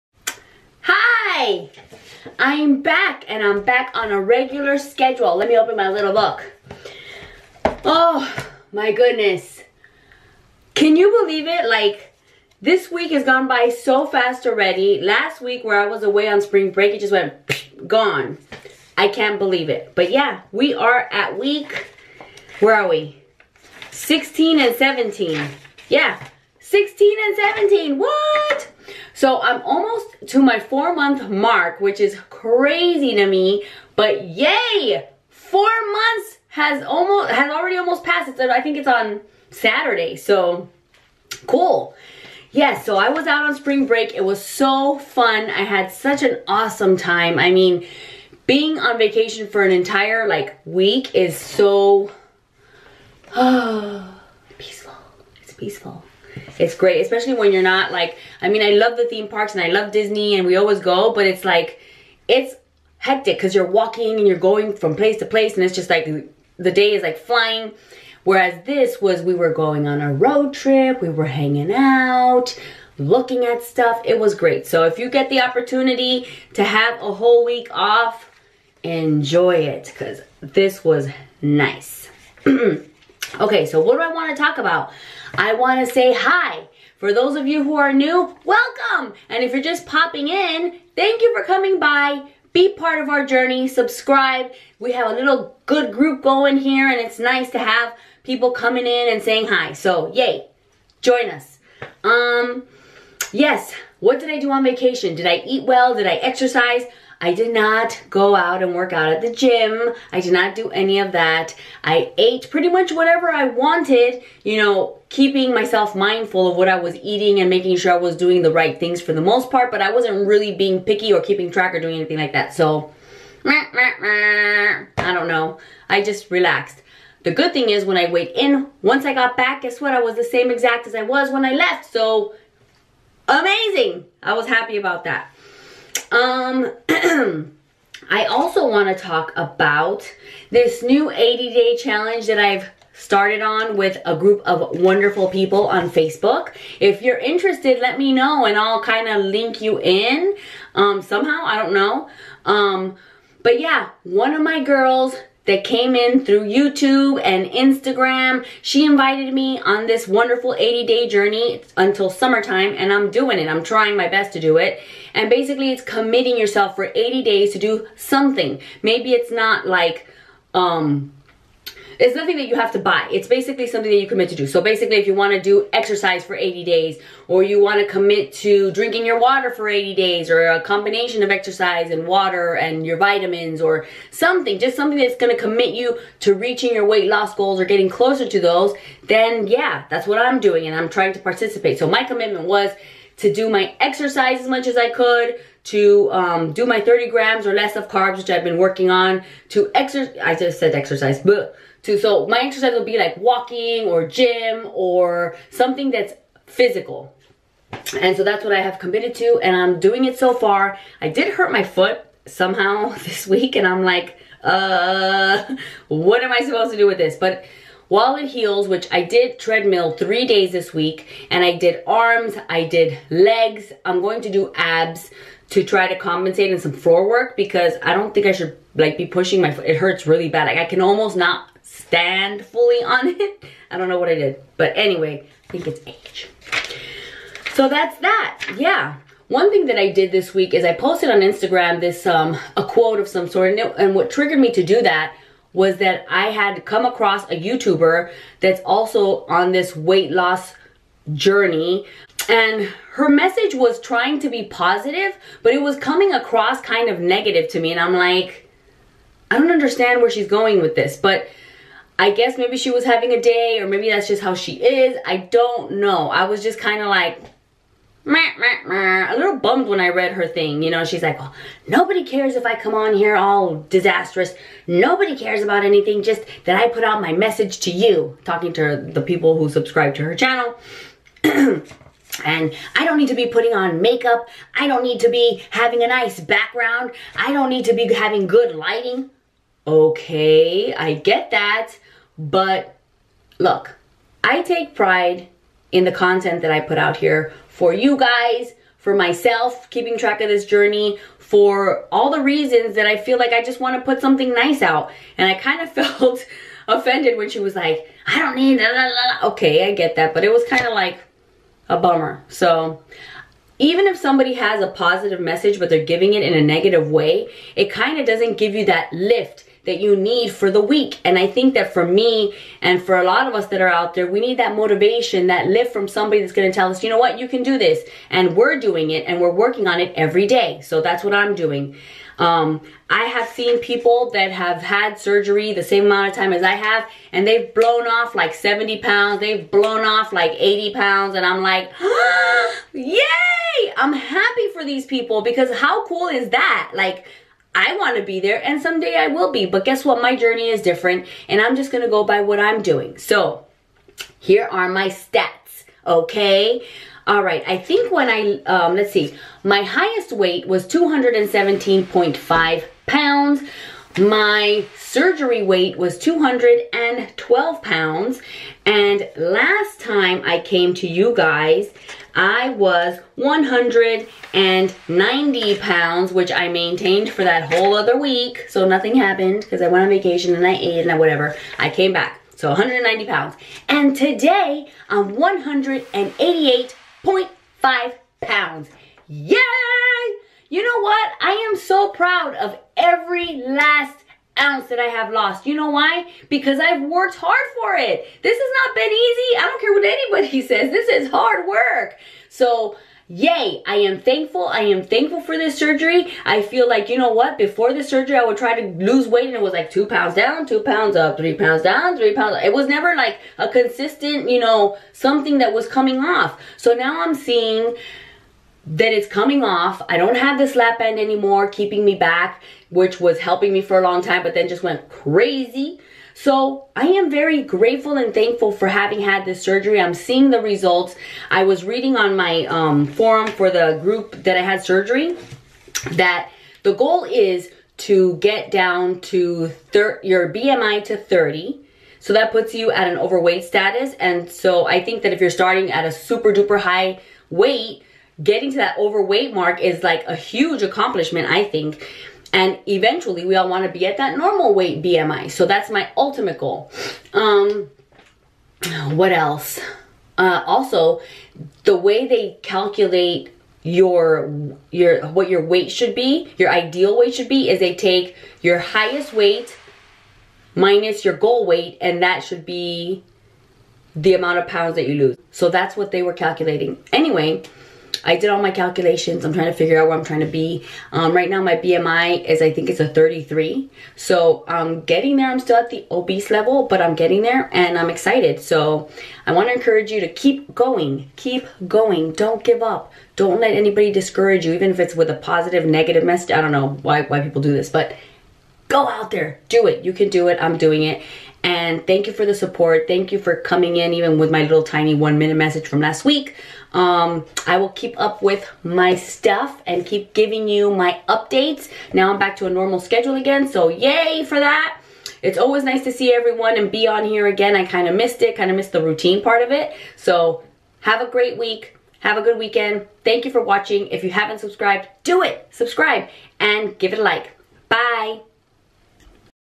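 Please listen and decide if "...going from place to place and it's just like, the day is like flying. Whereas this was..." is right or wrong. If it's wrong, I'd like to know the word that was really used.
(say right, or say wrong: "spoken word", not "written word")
right.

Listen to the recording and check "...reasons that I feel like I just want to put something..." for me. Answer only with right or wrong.
right.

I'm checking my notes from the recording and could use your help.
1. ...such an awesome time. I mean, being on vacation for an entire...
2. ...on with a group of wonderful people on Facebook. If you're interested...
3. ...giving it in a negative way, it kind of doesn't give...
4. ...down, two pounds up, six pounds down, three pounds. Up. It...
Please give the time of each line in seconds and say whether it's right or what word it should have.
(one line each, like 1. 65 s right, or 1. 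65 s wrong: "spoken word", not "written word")
1. 45 s right
2. 143 s right
3. 315 s right
4. 410 s wrong: "three", not "six".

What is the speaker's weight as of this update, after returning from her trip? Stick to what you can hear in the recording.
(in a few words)
188.5 pounds.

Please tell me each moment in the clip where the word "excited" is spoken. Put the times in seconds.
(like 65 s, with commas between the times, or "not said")
487 s.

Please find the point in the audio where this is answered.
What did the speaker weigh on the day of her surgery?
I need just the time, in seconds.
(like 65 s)
365 s.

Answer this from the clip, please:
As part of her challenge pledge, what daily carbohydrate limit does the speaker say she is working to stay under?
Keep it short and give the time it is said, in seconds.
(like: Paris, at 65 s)
30 grams, at 196 s.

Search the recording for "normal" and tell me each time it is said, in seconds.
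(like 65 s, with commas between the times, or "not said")
454 s, 512 s.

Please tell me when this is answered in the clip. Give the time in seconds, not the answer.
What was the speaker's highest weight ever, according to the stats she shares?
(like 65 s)
360 s.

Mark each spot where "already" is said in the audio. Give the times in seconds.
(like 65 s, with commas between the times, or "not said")
14 s, 37 s.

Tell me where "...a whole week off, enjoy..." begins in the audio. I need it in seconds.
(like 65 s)
77 s.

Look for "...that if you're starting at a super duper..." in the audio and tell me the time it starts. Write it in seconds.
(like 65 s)
445 s.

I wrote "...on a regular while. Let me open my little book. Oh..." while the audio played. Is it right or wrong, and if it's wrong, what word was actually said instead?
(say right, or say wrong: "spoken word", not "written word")
wrong: "schedule", not "while".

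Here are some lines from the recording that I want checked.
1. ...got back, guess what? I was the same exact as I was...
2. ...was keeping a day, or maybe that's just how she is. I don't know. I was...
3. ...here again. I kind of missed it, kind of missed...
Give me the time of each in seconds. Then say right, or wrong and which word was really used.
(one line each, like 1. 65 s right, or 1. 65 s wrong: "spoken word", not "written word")
1. 129 s right
2. 262 s wrong: "having", not "keeping"
3. 517 s right.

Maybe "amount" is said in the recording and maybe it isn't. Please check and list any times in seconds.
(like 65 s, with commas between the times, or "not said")
335 s, 474 s.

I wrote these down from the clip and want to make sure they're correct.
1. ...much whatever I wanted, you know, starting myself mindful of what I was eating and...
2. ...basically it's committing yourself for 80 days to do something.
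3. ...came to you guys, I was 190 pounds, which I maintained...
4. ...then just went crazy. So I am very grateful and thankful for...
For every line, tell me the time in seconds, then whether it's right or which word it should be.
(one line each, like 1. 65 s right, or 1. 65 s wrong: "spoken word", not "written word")
1. 112 s wrong: "keeping", not "starting"
2. 165 s right
3. 370 s right
4. 424 s right.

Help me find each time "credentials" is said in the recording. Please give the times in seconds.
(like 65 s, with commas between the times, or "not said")
not said.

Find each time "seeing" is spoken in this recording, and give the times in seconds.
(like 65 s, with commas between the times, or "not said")
417 s, 429 s.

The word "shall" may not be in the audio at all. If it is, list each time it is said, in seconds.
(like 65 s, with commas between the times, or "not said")
not said.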